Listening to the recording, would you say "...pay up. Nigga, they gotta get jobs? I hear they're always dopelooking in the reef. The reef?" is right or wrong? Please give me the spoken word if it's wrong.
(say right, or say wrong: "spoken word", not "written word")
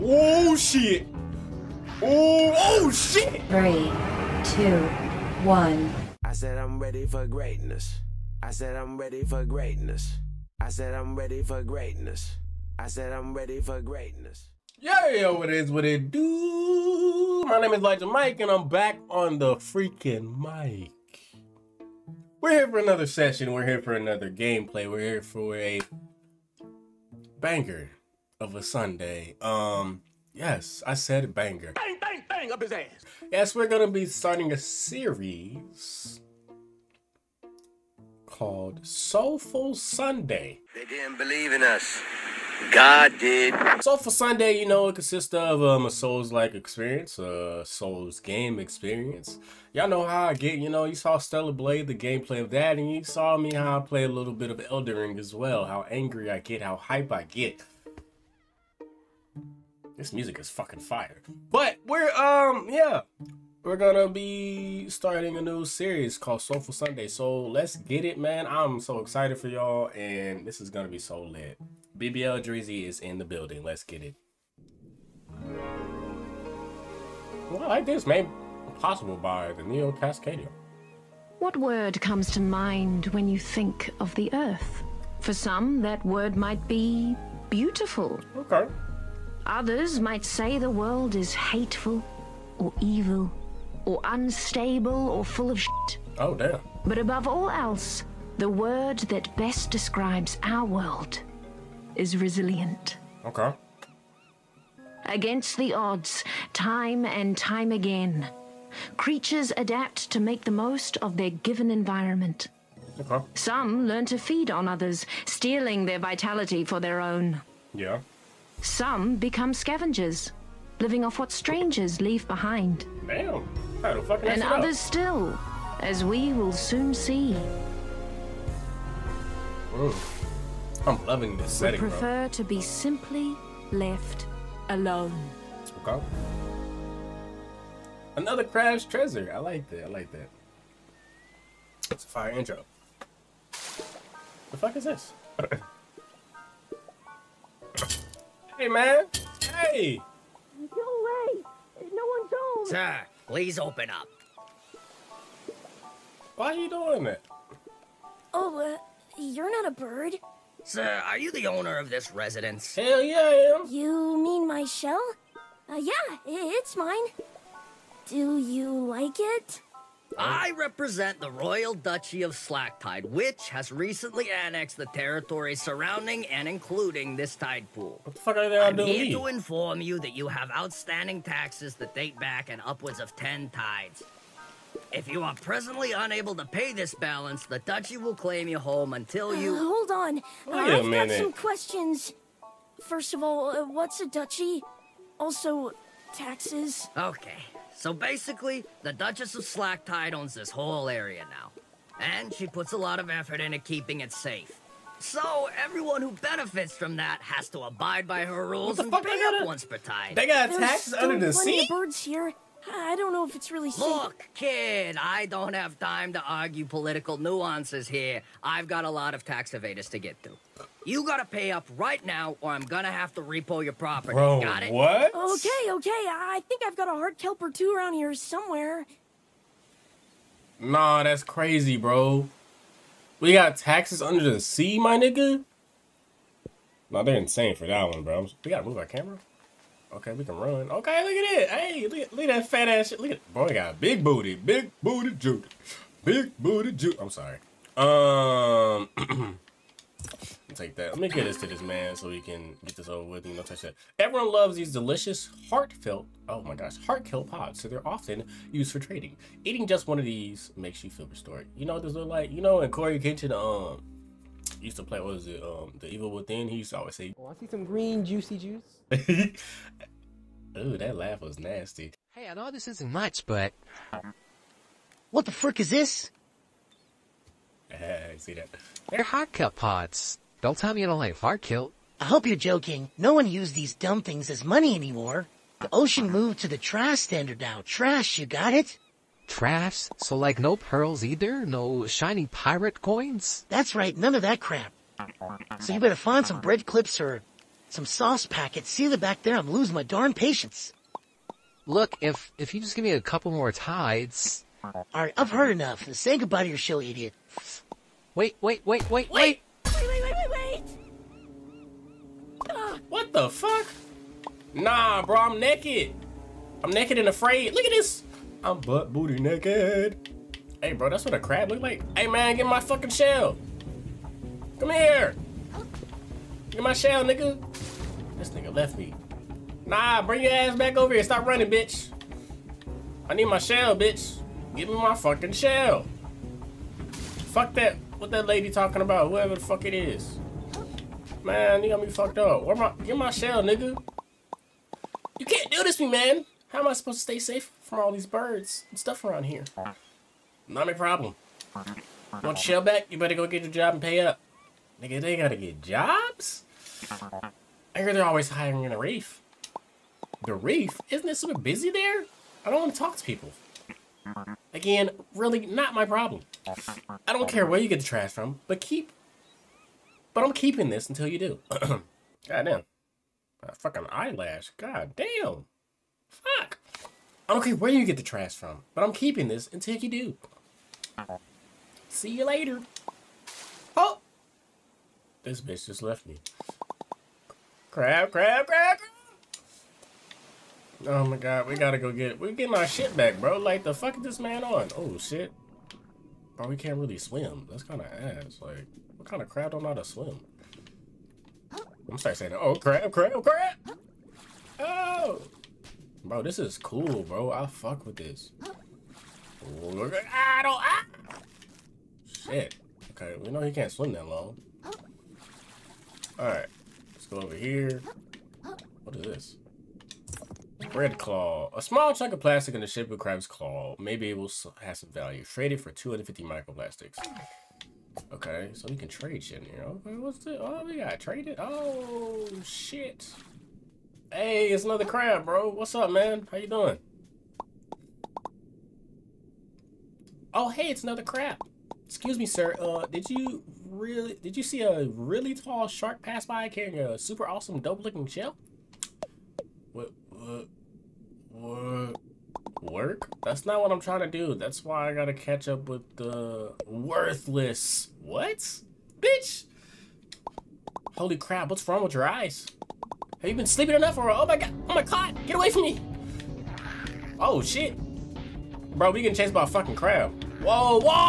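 wrong: "hiring", not "dopelooking".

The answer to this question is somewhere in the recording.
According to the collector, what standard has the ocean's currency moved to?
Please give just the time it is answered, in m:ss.
4:46.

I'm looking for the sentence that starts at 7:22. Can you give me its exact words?
Uh, did you really did you see a really tall shark pass by carrying a super awesome dope-looking shell?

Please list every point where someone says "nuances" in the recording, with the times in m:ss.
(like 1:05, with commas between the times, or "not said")
3:37.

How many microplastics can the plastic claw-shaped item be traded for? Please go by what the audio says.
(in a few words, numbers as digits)
250.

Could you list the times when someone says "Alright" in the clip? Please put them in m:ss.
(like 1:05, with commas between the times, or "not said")
5:04, 6:56.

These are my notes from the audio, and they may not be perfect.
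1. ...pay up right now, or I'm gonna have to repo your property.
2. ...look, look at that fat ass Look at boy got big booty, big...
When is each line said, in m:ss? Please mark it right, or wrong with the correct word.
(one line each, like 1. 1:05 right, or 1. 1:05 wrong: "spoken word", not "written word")
1. 3:41 right
2. 4:01 right.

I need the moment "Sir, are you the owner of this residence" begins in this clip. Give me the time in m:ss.
2:40.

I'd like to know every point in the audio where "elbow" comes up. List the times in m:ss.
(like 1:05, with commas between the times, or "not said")
not said.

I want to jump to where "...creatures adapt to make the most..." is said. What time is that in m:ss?
1:48.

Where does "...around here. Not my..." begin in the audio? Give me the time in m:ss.
5:49.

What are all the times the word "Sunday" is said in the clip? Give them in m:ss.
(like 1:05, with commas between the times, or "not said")
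0:28, 0:39, 0:44, 1:06.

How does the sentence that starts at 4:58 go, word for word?
See the back there, I'm losing my darn patience.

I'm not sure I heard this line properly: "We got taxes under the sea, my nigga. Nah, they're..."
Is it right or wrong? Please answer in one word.
right.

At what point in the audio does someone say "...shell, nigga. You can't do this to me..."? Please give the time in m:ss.
5:43.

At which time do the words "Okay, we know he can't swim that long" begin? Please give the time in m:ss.
6:52.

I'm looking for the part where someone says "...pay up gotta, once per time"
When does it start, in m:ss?
3:28.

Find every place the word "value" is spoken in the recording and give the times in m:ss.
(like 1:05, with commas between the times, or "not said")
7:04.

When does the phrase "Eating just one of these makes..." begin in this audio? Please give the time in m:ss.
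4:19.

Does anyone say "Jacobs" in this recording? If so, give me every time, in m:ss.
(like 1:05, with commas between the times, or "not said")
not said.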